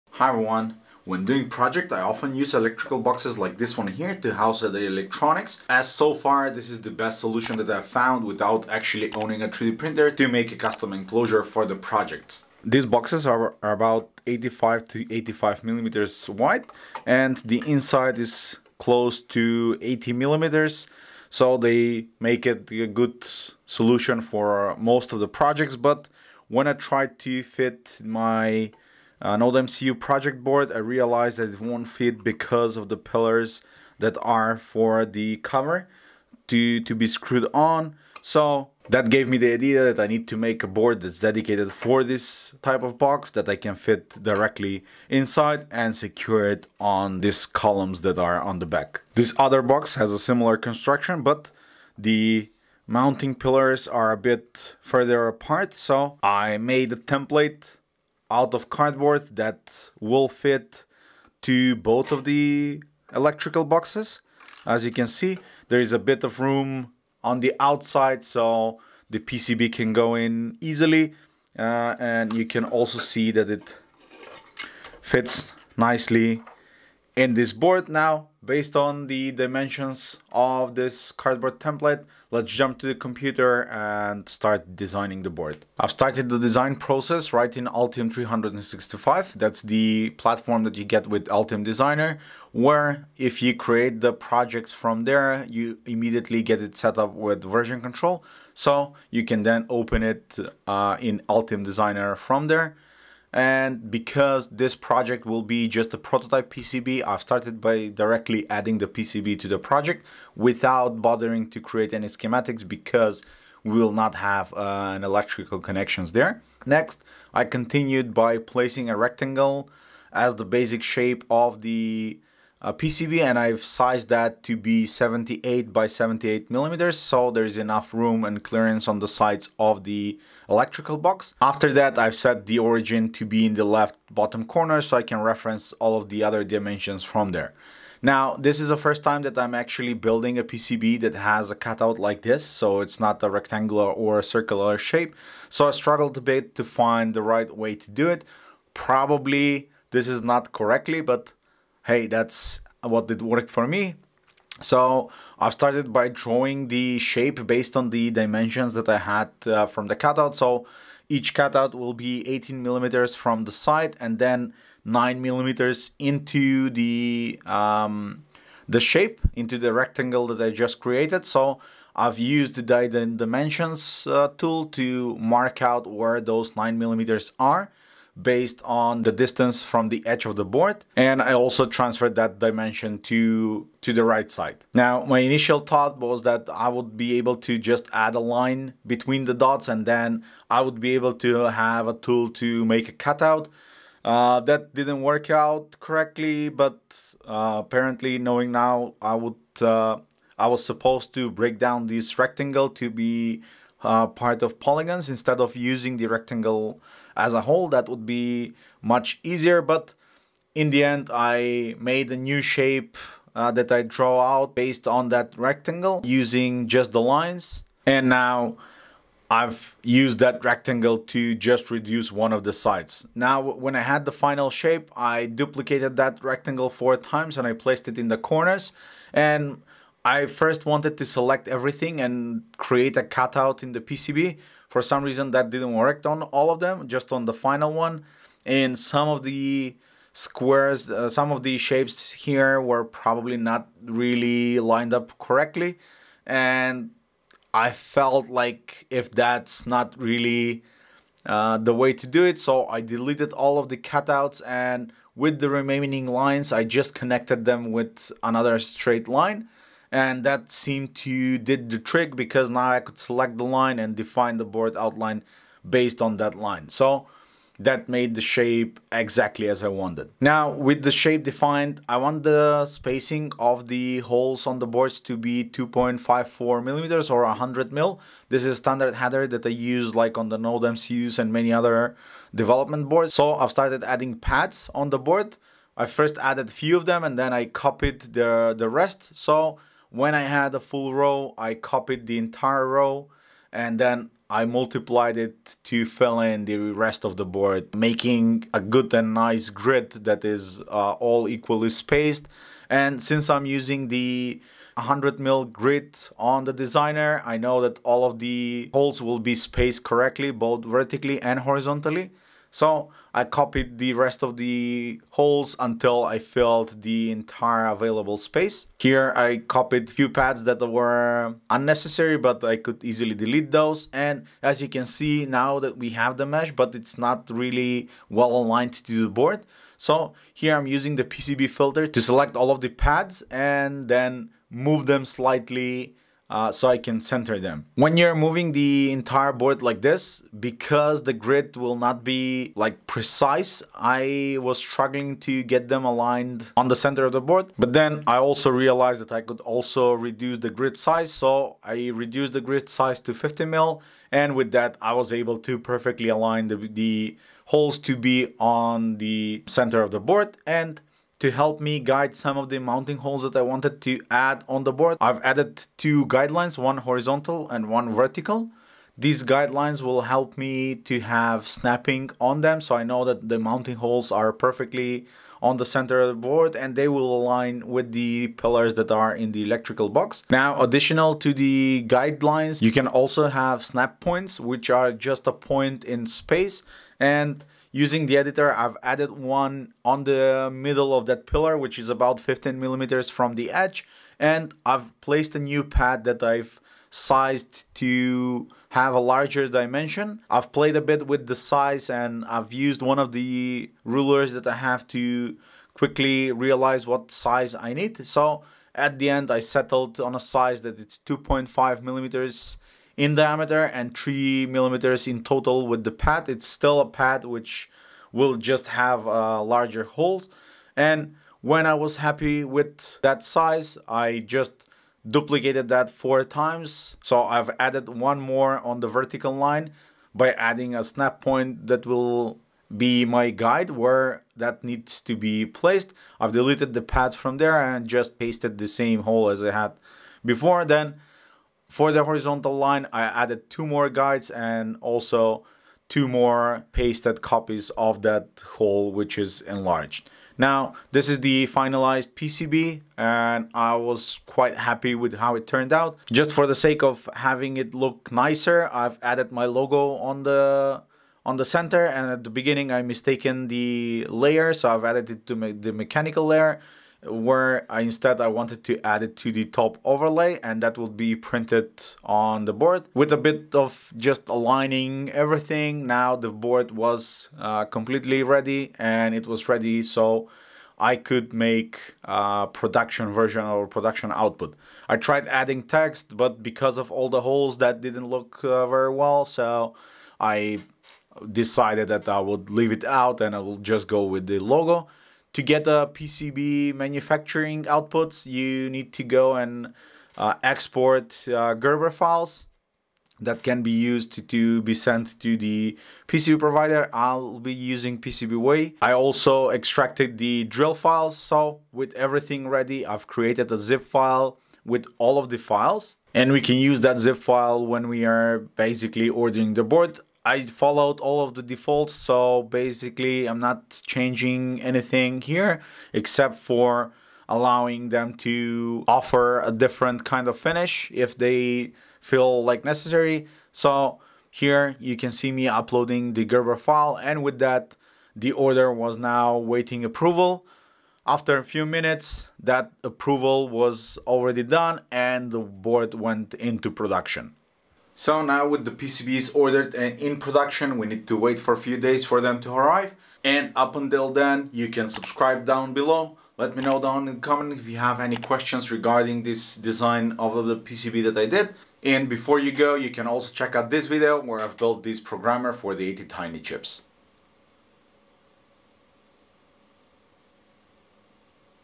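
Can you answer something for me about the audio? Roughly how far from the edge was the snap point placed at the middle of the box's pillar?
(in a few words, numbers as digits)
15 millimeters.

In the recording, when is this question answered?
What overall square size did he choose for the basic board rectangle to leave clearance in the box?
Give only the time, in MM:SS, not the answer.
02:04.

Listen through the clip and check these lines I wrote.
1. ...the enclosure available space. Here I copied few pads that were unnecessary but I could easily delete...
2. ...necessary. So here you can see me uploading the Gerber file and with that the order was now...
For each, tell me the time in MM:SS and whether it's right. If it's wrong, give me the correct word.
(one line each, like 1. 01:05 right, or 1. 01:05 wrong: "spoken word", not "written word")
1. 05:16 wrong: "entire", not "enclosure"
2. 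08:52 right.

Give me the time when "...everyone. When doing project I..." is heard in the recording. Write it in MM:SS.
00:00.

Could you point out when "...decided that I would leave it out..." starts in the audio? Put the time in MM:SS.
08:11.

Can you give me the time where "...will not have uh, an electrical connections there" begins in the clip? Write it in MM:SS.
01:53.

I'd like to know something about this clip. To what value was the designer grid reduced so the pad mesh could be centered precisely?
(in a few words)
50 mil.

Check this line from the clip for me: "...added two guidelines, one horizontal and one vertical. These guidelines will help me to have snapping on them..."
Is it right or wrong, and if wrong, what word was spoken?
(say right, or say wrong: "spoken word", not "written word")
right.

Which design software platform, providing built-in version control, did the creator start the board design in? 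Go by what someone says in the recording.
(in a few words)
Altium 365.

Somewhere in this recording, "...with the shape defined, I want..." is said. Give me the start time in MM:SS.
04:30.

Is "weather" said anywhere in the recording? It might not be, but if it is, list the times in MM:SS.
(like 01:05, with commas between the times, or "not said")
not said.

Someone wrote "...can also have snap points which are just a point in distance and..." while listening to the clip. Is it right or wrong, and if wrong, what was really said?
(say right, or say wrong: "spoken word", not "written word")
wrong: "space", not "distance".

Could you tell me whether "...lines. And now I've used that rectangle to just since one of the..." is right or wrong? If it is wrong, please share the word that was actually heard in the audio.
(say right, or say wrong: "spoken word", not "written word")
wrong: "reduce", not "since".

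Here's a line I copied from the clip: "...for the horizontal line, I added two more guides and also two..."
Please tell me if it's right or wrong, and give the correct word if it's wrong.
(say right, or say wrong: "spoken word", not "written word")
right.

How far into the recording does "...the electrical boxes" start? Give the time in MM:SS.
01:02.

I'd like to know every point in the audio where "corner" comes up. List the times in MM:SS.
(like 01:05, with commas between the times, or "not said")
02:14, 03:48.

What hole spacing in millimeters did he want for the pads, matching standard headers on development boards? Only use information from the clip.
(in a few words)
2.54 millimeters.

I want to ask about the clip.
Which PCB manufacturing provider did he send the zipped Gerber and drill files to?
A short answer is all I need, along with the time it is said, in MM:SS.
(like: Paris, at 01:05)
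PCBWay, at 08:27.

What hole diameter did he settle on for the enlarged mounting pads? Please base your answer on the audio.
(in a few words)
2.5 millimeters.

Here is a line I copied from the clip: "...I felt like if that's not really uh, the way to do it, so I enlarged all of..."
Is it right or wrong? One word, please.
wrong.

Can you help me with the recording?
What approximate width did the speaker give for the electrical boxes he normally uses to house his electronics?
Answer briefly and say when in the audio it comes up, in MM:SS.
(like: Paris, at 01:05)
85 millimeters, at 00:15.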